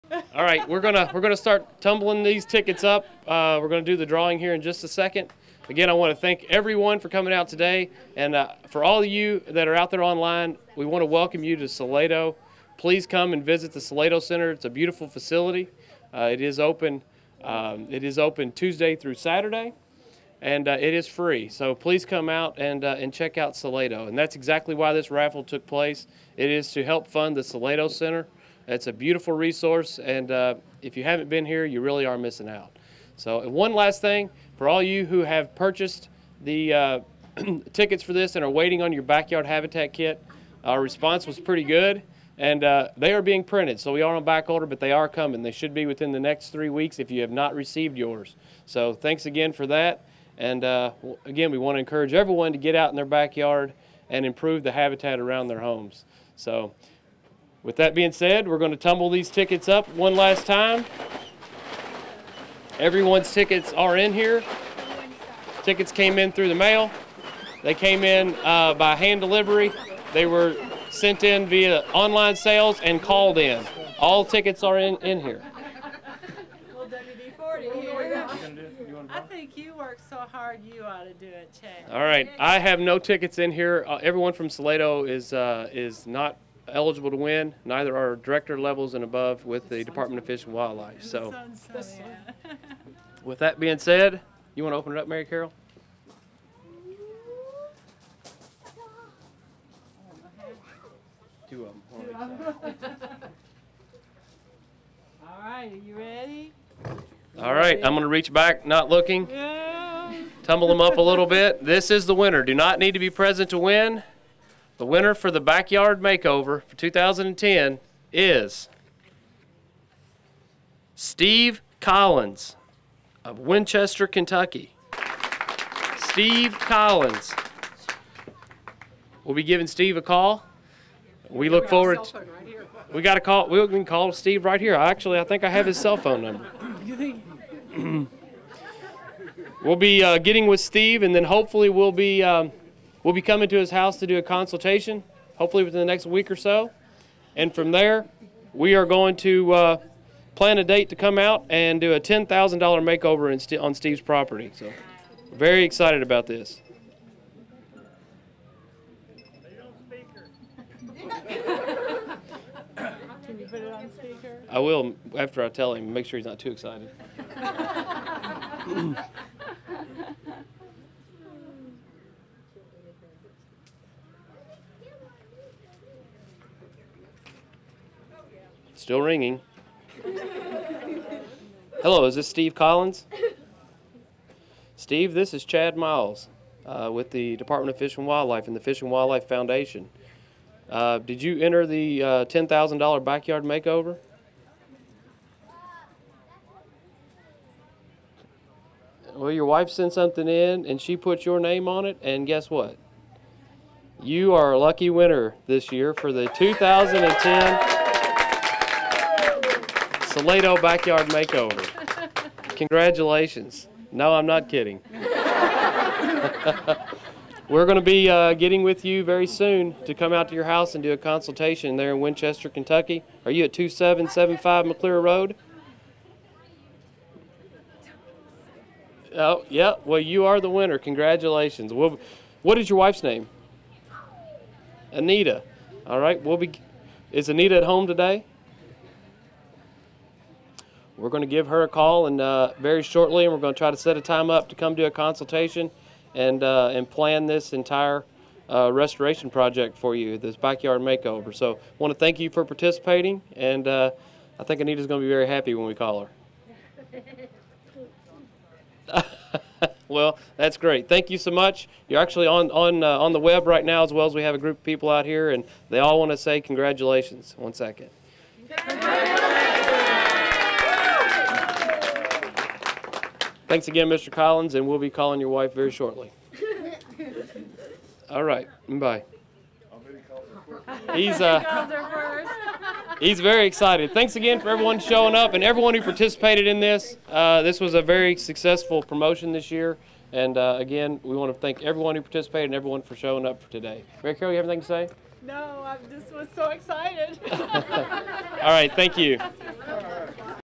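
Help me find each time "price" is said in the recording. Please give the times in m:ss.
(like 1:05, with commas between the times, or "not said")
not said.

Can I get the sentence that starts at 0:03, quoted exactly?
Uh, we're gonna do the drawing here in just a second.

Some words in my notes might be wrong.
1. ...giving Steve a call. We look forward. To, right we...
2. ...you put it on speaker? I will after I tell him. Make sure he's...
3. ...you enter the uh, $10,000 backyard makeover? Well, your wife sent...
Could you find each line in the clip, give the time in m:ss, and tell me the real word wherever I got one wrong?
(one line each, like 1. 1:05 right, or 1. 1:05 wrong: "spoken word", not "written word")
1. 2:09 right
2. 2:43 right
3. 3:11 right.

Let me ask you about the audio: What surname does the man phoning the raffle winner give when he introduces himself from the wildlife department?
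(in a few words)
Miles.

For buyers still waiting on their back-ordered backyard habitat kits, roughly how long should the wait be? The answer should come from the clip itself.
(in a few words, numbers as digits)
3 weeks.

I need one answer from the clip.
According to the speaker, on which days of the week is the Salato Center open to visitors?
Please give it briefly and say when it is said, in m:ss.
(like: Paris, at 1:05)
Tuesday through Saturday, at 0:18.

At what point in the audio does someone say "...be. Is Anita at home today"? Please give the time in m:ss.
3:56.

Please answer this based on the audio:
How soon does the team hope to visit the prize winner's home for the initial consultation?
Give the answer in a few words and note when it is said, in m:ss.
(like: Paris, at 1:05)
Within the next week, at 2:25.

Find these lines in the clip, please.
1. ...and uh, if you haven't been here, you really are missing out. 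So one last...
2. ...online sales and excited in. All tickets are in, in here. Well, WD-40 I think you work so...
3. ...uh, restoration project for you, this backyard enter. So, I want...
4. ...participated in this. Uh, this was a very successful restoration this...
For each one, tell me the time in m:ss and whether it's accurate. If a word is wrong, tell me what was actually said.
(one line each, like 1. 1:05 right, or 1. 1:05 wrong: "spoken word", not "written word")
1. 0:29 right
2. 1:11 wrong: "called", not "excited"
3. 4:08 wrong: "makeover", not "enter"
4. 4:45 wrong: "promotion", not "restoration".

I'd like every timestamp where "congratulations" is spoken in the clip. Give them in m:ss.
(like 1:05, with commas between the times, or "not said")
3:32, 3:50, 4:26.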